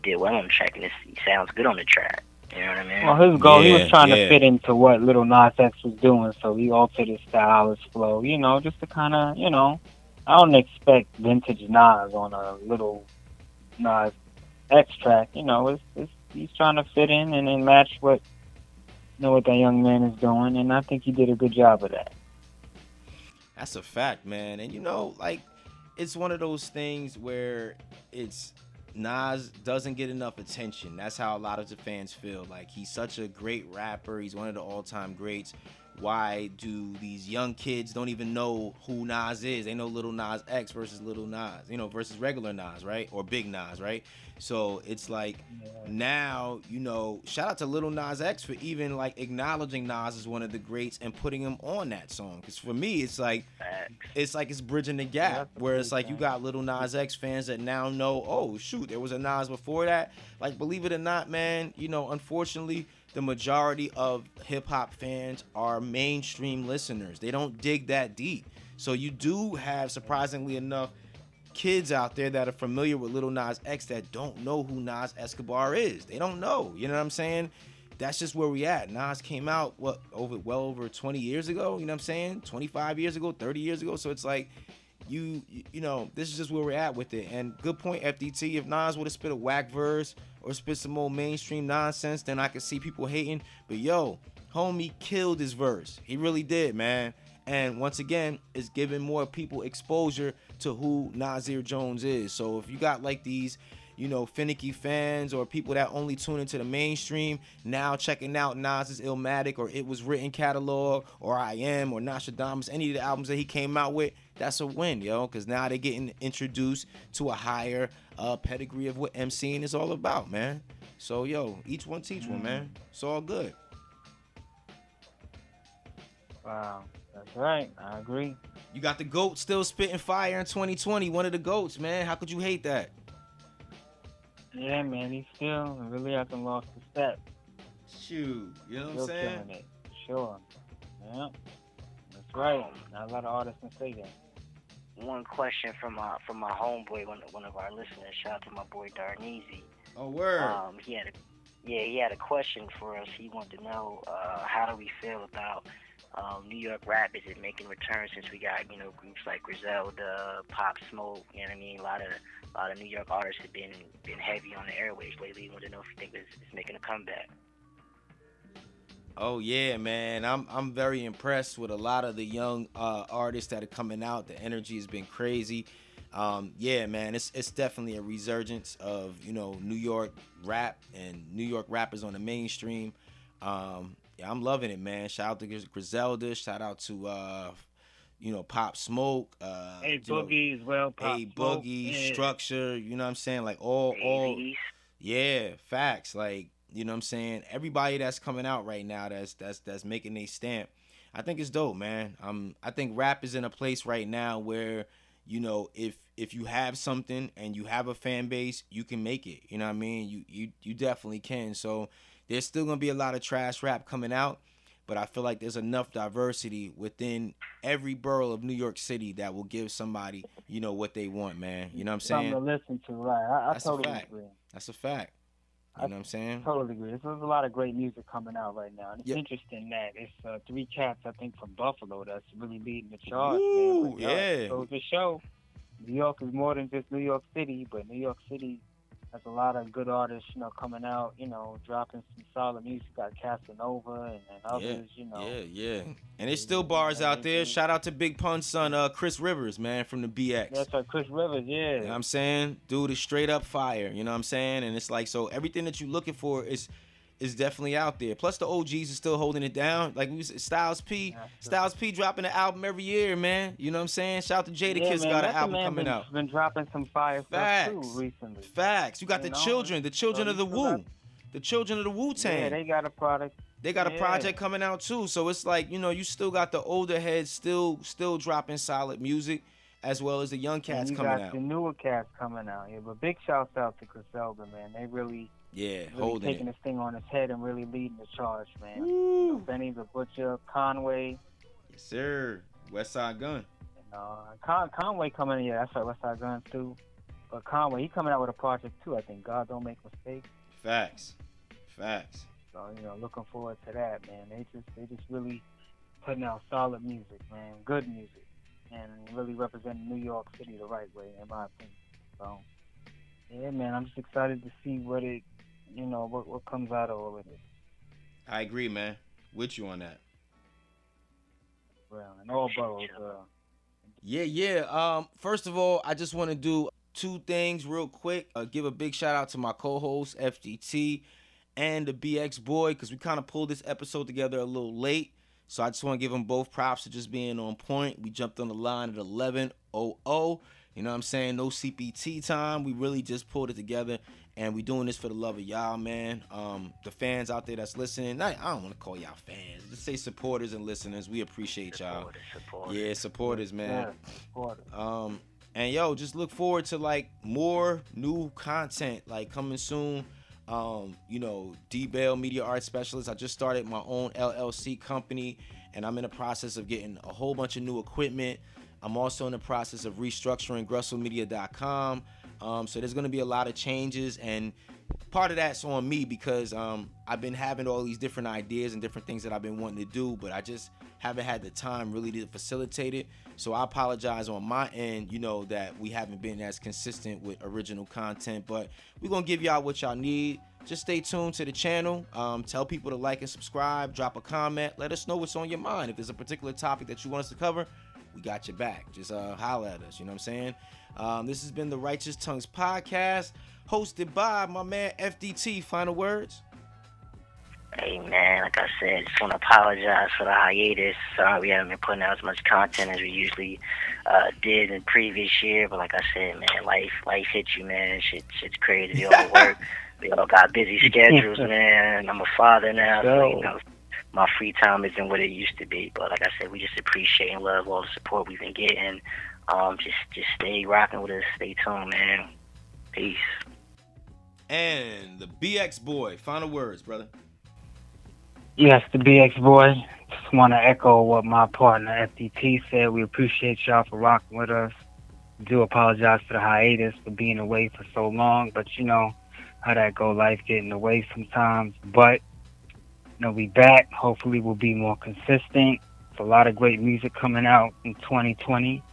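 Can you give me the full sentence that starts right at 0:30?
That's how a lot of the fans feel.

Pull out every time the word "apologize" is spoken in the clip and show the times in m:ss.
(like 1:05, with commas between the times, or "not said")
6:23, 6:49, 7:25.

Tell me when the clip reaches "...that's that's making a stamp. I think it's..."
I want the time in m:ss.
3:19.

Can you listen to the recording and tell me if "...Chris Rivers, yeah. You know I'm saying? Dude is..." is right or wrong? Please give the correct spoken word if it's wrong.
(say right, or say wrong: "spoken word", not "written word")
right.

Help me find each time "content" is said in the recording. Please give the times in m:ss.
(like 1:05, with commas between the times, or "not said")
5:58, 6:27, 6:52.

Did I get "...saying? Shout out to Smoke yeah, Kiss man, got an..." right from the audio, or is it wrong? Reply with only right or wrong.
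wrong.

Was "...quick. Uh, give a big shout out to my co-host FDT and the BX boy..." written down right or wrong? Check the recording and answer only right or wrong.
right.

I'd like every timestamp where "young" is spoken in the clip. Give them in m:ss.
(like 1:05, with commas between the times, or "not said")
0:19, 0:37, 2:52, 4:40.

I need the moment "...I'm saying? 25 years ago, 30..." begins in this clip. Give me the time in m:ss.
1:22.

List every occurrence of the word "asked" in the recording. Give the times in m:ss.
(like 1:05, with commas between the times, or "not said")
not said.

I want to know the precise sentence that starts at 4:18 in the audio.
Plus the OGs are still holding it down.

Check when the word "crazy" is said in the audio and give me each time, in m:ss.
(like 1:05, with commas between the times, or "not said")
2:55, 6:58.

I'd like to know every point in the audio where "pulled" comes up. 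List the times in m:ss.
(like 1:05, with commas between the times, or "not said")
5:33, 5:43.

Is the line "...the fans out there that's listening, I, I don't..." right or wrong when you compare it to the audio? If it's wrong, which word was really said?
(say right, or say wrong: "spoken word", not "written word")
right.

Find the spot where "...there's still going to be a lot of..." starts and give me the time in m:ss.
3:32.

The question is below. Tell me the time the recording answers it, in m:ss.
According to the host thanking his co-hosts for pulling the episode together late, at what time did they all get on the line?
5:38.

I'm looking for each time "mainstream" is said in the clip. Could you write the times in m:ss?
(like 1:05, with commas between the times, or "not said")
1:05, 1:31, 1:46, 3:02.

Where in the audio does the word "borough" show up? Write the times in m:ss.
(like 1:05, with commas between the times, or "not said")
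3:37, 5:22.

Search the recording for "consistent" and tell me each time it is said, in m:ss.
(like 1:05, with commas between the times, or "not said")
6:26, 7:34.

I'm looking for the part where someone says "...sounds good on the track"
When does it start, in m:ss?
0:01.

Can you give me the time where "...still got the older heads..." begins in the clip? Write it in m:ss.
4:36.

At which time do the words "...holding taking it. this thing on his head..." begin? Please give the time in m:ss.
4:45.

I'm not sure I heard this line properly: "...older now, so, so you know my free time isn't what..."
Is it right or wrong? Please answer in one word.
wrong.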